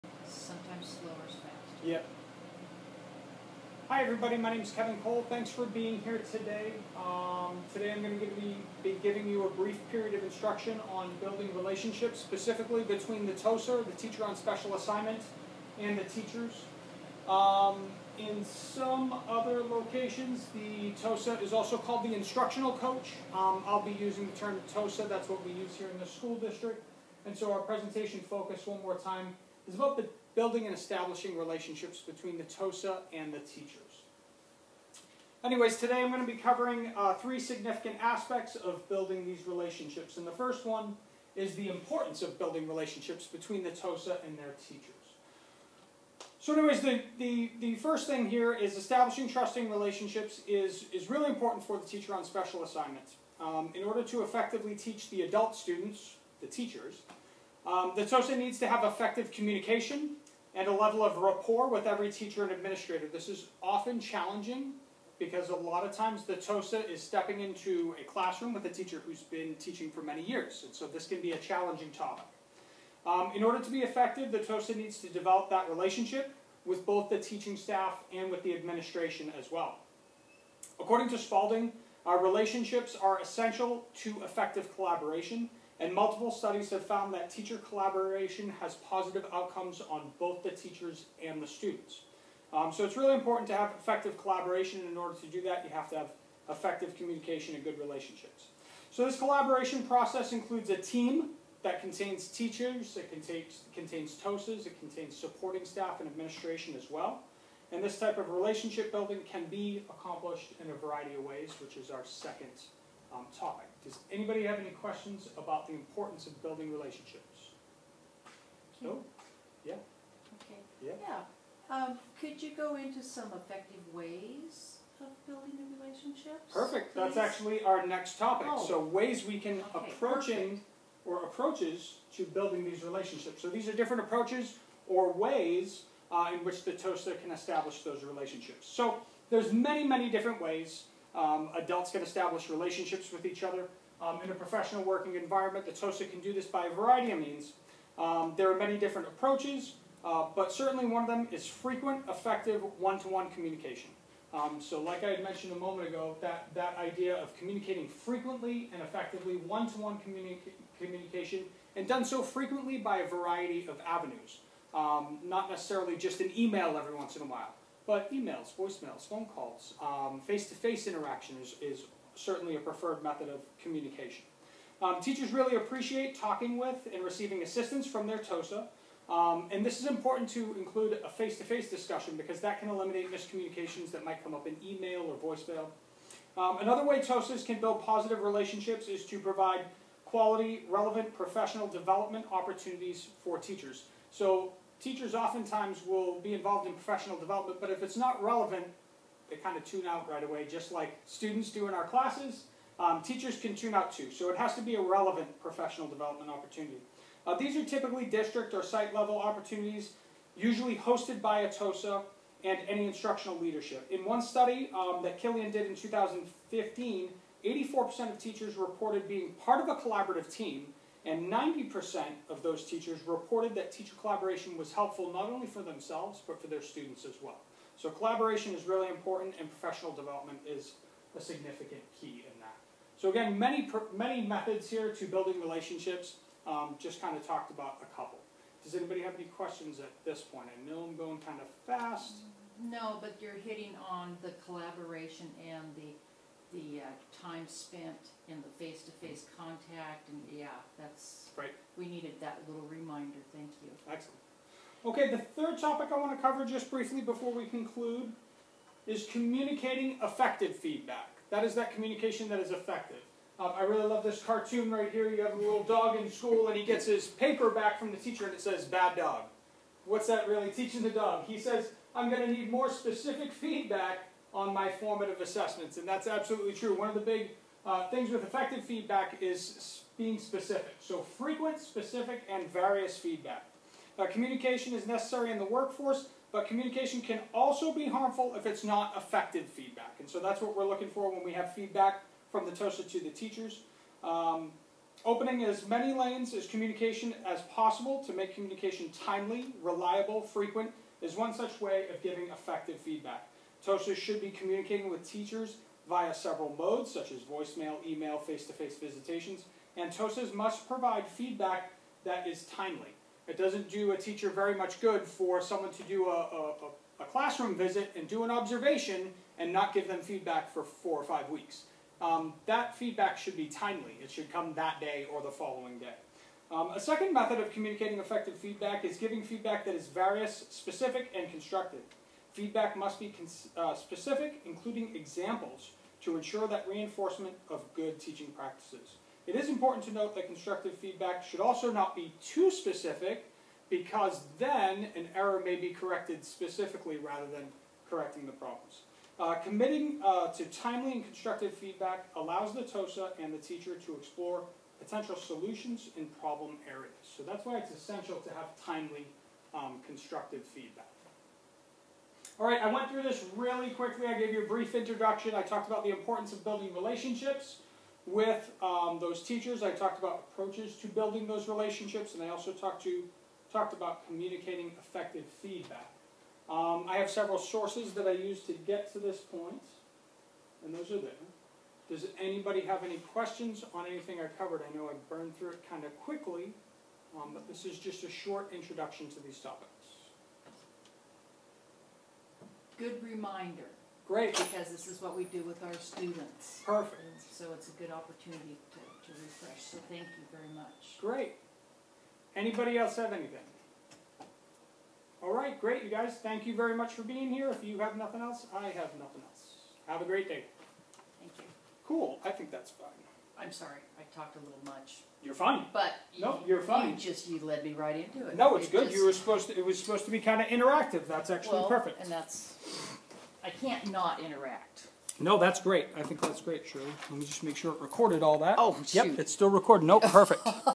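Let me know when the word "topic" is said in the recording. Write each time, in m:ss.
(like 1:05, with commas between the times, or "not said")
1:11, 1:53, 2:08, 4:15, 6:29.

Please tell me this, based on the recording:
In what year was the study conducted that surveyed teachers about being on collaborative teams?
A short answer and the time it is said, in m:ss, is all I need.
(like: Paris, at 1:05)
2015, at 3:35.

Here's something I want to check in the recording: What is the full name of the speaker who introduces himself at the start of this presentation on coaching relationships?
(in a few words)
Kevin Cole.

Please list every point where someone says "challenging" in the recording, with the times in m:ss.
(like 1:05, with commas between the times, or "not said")
1:03, 1:11.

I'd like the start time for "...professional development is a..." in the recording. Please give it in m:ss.
3:49.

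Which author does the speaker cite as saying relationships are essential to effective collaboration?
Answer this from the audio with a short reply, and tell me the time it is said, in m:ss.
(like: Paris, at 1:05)
Spalding, at 1:21.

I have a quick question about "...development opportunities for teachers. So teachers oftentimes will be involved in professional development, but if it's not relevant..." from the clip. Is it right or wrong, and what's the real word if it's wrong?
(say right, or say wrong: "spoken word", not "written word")
right.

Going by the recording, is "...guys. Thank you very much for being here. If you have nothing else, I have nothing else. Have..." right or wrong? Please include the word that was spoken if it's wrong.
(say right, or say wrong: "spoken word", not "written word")
right.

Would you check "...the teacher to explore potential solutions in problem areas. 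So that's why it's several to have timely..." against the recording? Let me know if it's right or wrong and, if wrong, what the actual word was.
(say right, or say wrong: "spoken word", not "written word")
wrong: "essential", not "several".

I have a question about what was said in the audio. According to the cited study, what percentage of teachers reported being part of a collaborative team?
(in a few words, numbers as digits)
84%.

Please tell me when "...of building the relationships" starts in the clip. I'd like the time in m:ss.
2:04.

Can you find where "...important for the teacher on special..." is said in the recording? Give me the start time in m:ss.
0:51.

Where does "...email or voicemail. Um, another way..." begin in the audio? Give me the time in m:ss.
3:04.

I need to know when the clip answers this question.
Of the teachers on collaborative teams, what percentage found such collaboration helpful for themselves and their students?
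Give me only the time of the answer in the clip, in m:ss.
3:41.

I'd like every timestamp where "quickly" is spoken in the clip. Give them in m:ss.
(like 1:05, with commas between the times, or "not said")
6:03, 6:25.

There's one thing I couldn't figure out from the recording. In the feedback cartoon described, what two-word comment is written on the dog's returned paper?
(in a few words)
bad dog.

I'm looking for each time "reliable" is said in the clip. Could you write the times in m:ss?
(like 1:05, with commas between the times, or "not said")
4:59.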